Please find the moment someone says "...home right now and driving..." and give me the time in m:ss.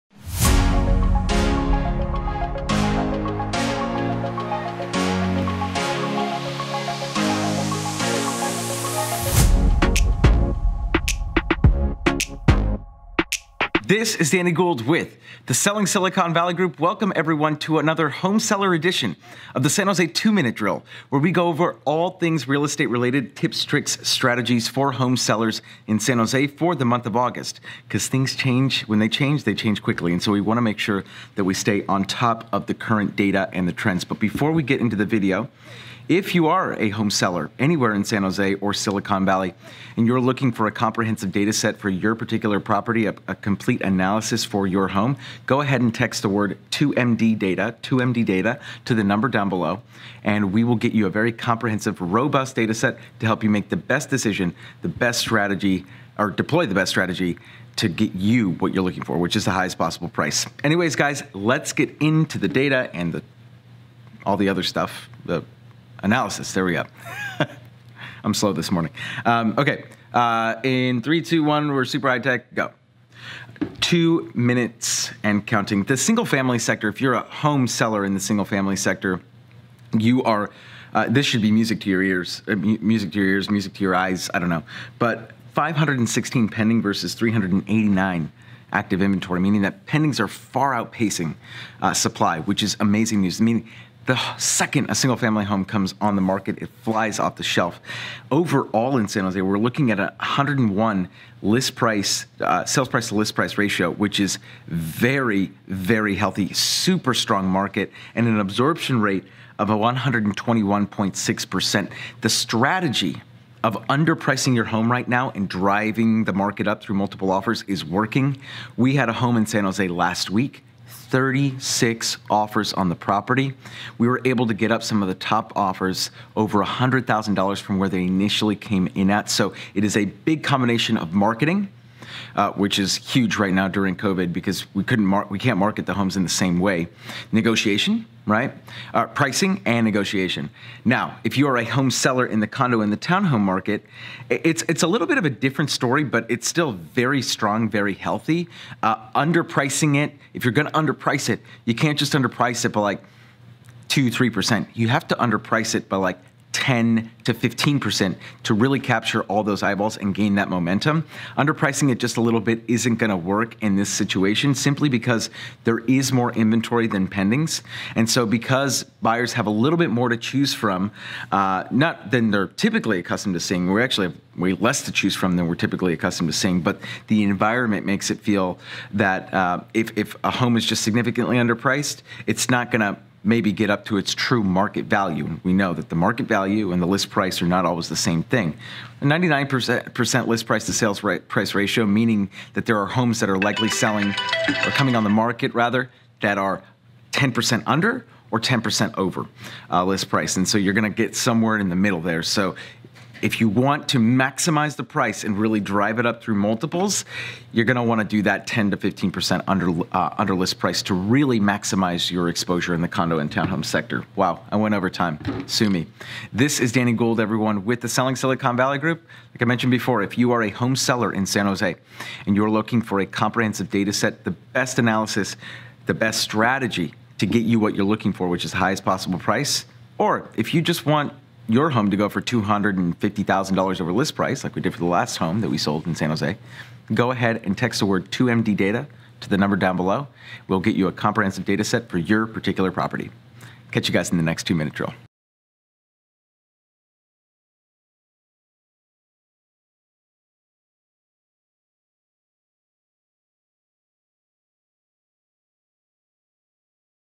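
1:54.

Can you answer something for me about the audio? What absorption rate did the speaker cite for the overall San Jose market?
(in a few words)
121.6%.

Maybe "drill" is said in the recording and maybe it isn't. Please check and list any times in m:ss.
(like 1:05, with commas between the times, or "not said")
0:20, 4:04.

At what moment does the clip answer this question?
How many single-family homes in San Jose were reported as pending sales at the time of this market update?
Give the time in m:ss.
1:25.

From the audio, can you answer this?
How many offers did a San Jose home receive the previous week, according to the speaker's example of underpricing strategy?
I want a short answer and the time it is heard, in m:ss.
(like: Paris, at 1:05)
36, at 2:00.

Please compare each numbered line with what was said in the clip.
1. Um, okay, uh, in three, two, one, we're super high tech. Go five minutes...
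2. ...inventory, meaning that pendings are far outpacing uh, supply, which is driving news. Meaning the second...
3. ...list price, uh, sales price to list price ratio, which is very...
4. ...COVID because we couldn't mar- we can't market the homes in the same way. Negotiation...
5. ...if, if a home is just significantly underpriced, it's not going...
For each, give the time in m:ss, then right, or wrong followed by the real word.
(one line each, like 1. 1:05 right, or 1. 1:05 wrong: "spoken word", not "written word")
1. 1:09 wrong: "two", not "five"
2. 1:29 wrong: "amazing", not "driving"
3. 1:41 right
4. 2:13 right
5. 2:59 right.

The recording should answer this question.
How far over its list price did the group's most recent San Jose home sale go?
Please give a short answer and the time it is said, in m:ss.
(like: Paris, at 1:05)
$250,000, at 3:52.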